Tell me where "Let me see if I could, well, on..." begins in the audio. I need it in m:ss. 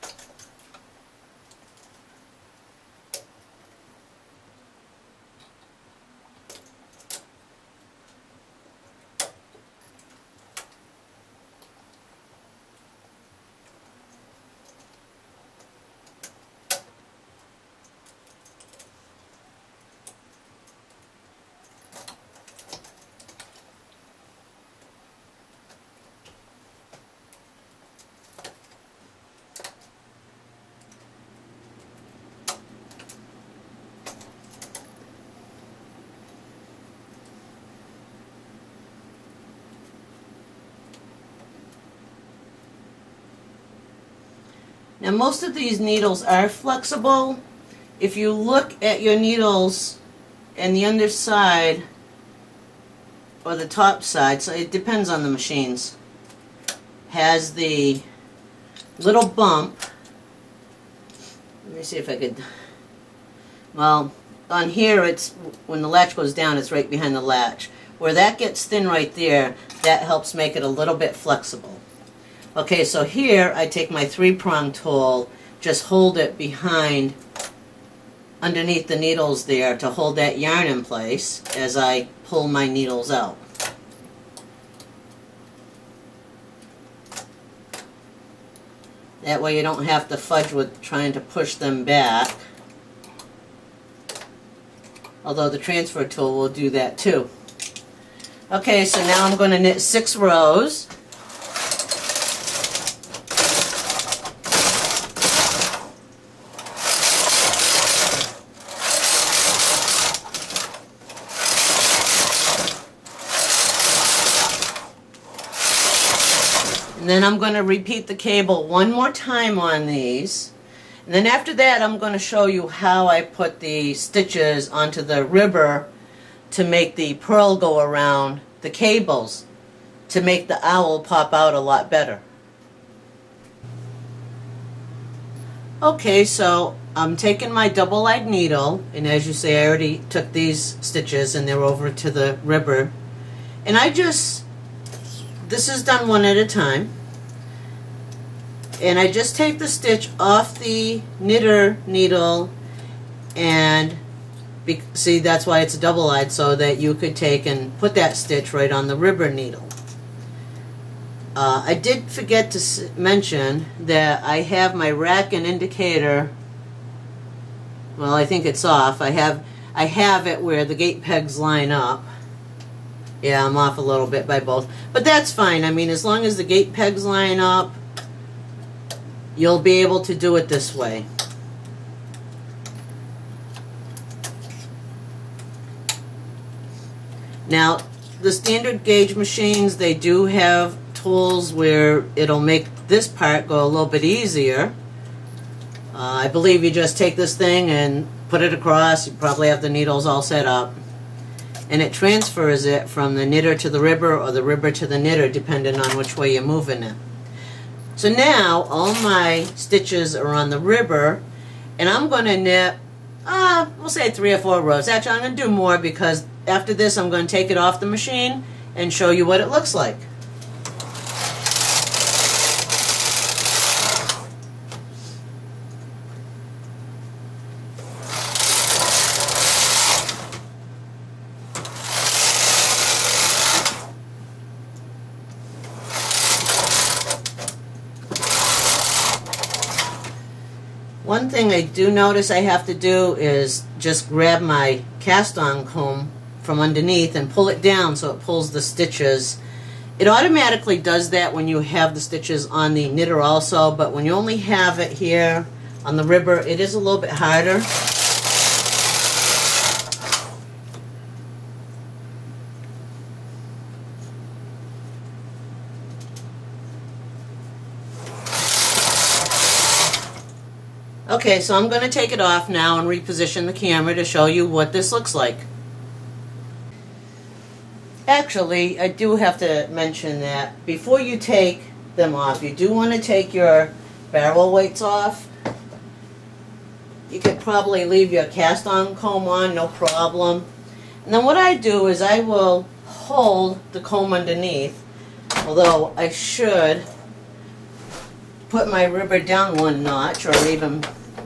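1:01.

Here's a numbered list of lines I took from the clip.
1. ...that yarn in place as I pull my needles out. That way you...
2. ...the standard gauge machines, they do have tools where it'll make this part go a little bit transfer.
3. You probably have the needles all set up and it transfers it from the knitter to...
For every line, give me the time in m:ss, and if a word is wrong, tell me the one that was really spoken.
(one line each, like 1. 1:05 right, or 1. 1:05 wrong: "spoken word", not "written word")
1. 1:20 right
2. 3:08 wrong: "easier", not "transfer"
3. 3:19 right.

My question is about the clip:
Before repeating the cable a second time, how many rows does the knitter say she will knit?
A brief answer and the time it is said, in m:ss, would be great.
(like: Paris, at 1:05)
6, at 1:39.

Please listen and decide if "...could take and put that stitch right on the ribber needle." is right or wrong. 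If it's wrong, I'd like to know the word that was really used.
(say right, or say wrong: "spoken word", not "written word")
right.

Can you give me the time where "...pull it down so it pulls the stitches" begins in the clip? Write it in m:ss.
4:07.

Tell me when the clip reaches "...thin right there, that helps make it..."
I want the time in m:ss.
1:08.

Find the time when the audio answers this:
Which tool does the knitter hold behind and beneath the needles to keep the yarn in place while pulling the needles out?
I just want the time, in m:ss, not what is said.
1:14.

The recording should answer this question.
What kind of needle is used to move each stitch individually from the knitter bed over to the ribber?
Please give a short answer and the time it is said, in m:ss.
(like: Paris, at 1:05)
double-eyed needle, at 2:17.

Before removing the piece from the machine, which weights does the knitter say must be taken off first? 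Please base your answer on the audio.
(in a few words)
barrel weights.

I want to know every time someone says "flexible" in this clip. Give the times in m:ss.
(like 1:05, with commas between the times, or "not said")
0:46, 1:11.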